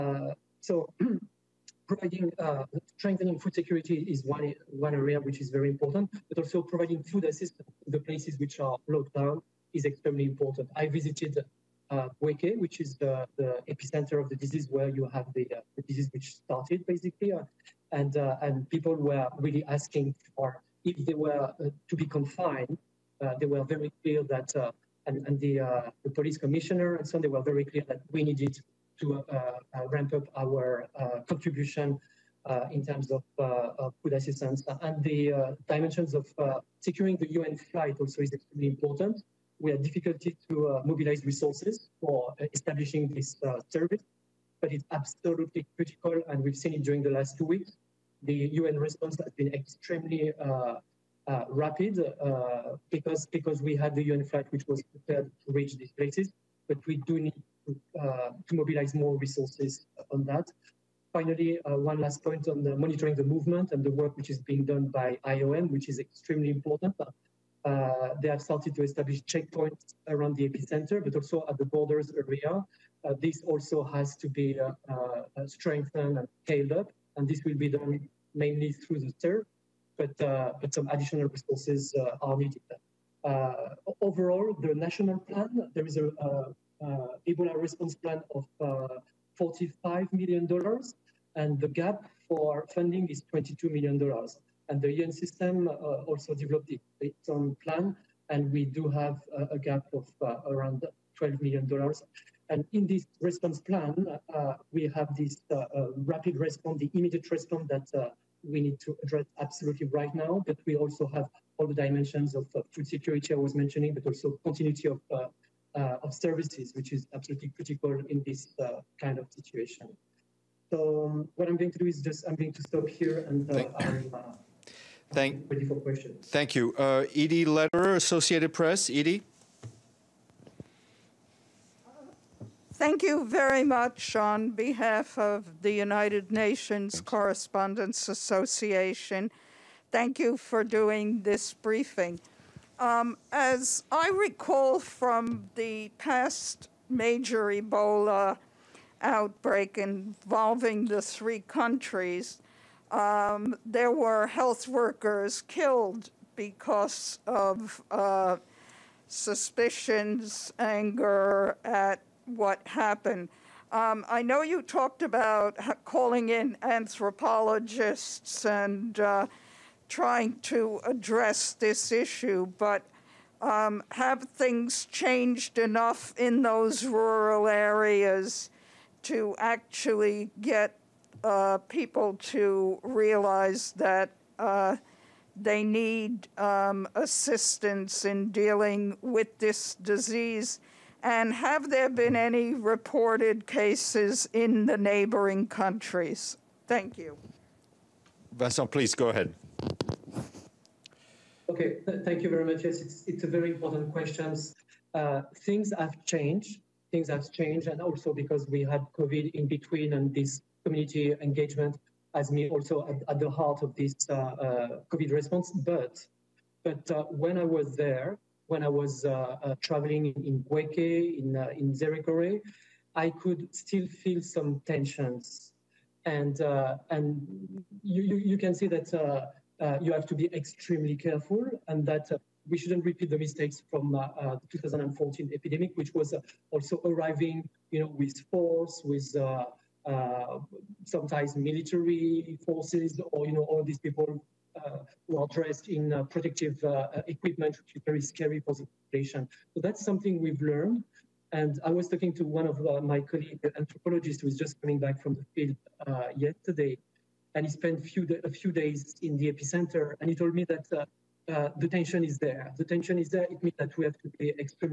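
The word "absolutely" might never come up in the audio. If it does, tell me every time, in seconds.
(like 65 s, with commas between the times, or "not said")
44 s, 109 s, 117 s.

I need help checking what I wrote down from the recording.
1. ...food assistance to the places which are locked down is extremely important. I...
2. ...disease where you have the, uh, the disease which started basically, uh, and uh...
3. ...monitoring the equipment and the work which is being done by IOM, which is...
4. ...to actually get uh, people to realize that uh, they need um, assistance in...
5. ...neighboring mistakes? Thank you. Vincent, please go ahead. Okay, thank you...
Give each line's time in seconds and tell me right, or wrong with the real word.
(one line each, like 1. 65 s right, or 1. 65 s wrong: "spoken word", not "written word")
1. 7 s right
2. 14 s right
3. 62 s wrong: "movement", not "equipment"
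4. 179 s right
5. 194 s wrong: "countries", not "mistakes".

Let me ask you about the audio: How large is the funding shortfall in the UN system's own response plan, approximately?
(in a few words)
$12 million.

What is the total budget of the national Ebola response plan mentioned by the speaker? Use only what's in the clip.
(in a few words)
$45 million.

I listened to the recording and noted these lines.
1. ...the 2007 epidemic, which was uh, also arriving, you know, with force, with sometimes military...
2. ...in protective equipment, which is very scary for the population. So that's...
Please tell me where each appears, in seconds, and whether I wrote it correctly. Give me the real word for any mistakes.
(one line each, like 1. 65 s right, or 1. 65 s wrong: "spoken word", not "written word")
1. 234 s wrong: "2014", not "2007"
2. 245 s right.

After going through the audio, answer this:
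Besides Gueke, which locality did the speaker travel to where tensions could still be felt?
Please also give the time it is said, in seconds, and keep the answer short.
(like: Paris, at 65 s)
Nzérékoré, at 221 s.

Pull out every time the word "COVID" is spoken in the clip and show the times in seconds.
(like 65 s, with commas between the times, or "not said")
208 s, 214 s.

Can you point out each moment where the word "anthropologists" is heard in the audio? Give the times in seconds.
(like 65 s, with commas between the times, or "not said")
166 s, 253 s.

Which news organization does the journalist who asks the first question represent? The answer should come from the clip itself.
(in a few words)
Associated Press.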